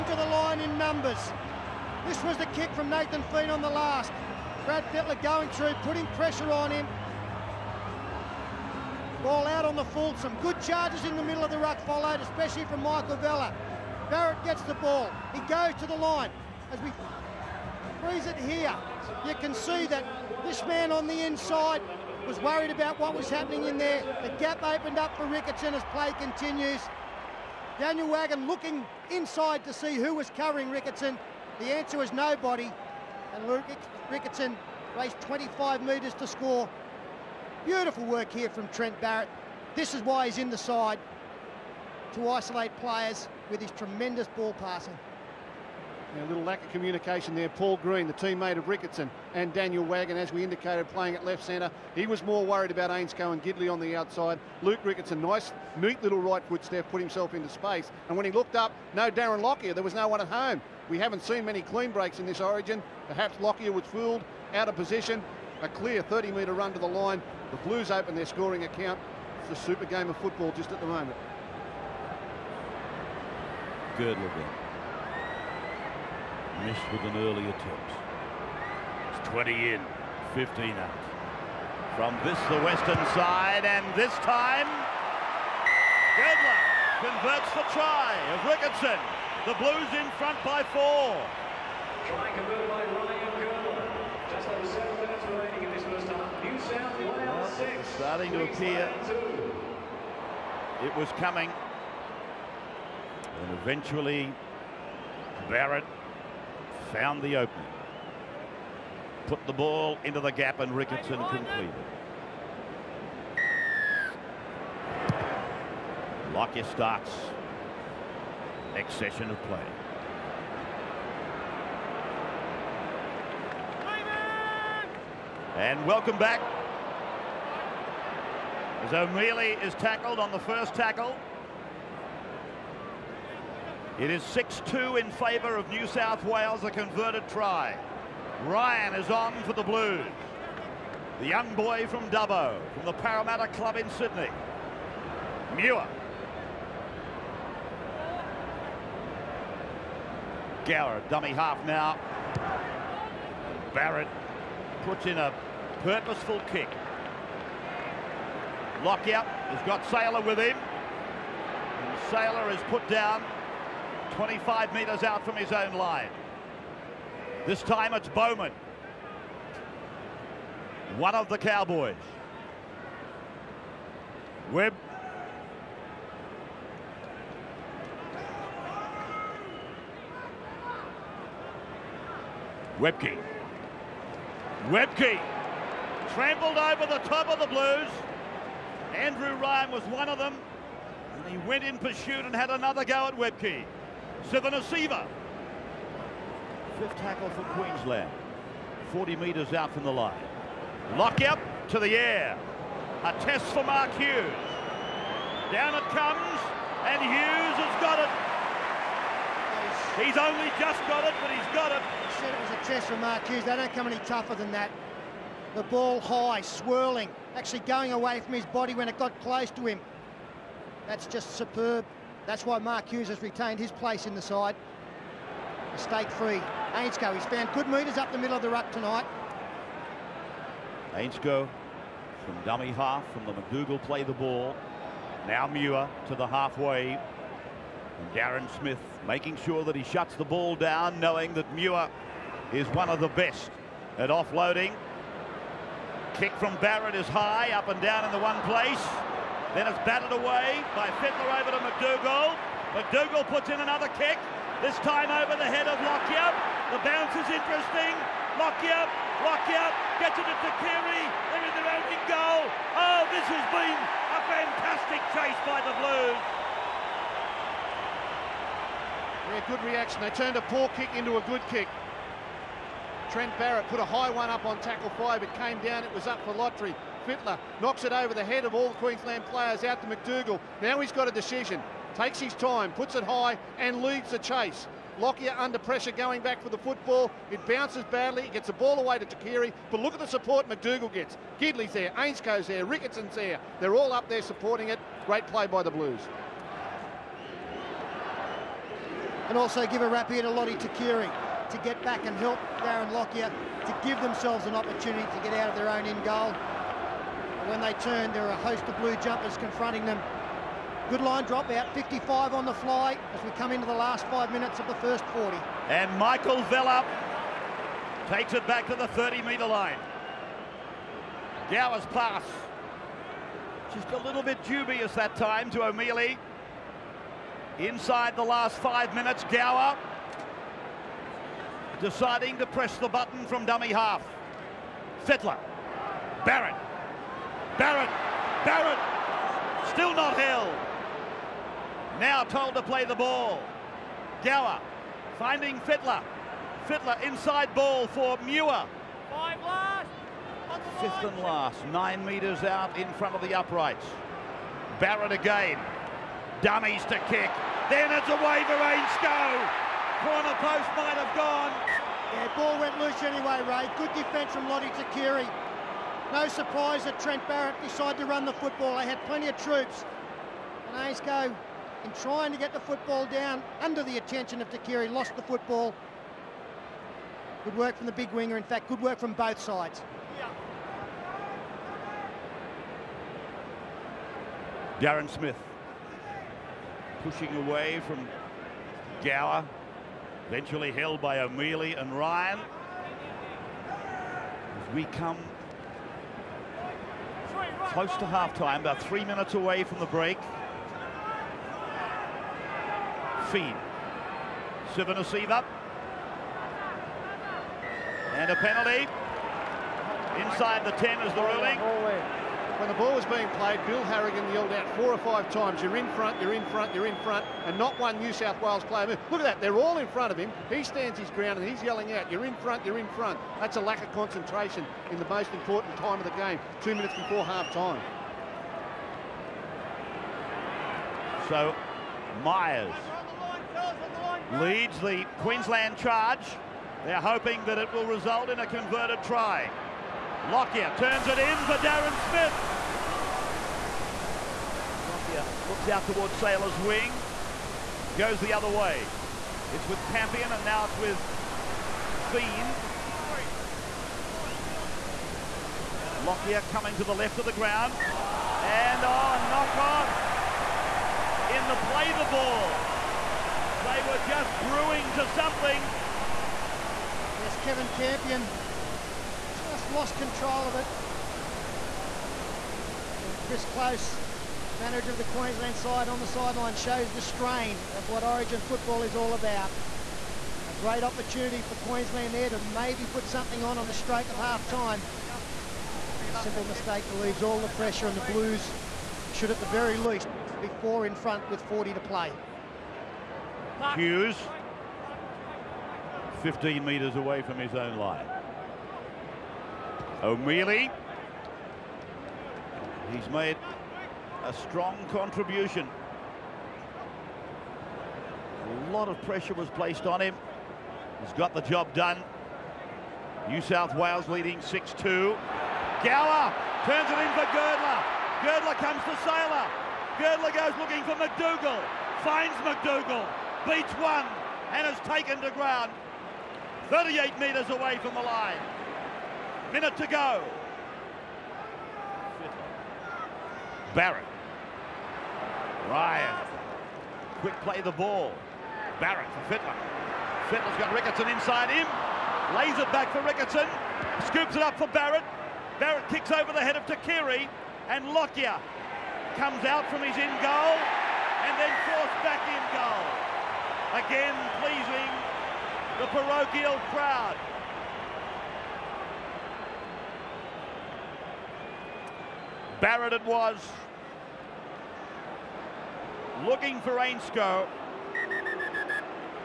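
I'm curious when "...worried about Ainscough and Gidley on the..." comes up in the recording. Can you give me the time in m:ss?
0:52.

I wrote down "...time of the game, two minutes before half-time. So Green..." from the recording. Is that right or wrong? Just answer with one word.
wrong.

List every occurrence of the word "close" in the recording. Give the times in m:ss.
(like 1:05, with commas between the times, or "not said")
3:39, 6:37, 7:53.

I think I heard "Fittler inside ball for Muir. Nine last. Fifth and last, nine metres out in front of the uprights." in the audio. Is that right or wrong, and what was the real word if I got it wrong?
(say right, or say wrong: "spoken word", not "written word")
wrong: "Five", not "Nine".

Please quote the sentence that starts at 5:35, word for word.
Fittler, Barrett, Barrett, Barrett, still not held.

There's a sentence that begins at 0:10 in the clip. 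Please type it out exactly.
Some Good charges in the middle of the ruck followed, especially from Michael Vella.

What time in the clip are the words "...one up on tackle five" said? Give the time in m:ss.
4:34.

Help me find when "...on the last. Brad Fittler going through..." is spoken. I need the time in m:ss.
0:03.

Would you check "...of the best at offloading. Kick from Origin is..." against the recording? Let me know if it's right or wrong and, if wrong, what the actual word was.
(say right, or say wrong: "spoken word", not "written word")
wrong: "Barrett", not "Origin".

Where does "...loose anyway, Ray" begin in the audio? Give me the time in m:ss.
6:02.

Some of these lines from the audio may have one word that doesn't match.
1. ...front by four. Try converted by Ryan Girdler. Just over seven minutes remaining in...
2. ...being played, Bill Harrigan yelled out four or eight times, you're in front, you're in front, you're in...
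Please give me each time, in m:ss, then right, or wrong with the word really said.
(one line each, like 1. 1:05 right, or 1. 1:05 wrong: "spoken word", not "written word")
1. 1:30 right
2. 6:53 wrong: "five", not "eight".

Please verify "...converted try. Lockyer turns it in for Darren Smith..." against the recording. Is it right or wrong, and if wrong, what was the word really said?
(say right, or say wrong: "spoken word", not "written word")
right.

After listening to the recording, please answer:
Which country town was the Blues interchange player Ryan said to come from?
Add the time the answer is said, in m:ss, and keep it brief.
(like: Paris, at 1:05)
Dubbo, at 2:22.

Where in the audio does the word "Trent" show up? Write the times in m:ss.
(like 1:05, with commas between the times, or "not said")
0:38, 4:33, 6:06.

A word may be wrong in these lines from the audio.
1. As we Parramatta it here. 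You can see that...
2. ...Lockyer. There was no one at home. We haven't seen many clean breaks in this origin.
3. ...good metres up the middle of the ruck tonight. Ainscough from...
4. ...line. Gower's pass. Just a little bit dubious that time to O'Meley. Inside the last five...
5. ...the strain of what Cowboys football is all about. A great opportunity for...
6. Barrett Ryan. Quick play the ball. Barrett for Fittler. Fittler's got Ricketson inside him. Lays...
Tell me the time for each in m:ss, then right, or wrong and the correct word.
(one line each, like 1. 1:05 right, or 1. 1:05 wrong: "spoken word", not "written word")
1. 0:16 wrong: "Freeze", not "Parramatta"
2. 0:59 right
3. 3:47 right
4. 5:19 right
5. 7:56 wrong: "Origin", not "Cowboys"
6. 8:53 right.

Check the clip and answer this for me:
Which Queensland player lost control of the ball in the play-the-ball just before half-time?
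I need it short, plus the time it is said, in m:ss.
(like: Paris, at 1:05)
Kevin Campion, at 7:47.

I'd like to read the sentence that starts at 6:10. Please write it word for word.
And go in trying to get the football down under the attention of Tuqiri, lost the football.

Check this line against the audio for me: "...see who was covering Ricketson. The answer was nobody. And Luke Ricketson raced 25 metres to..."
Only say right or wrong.
right.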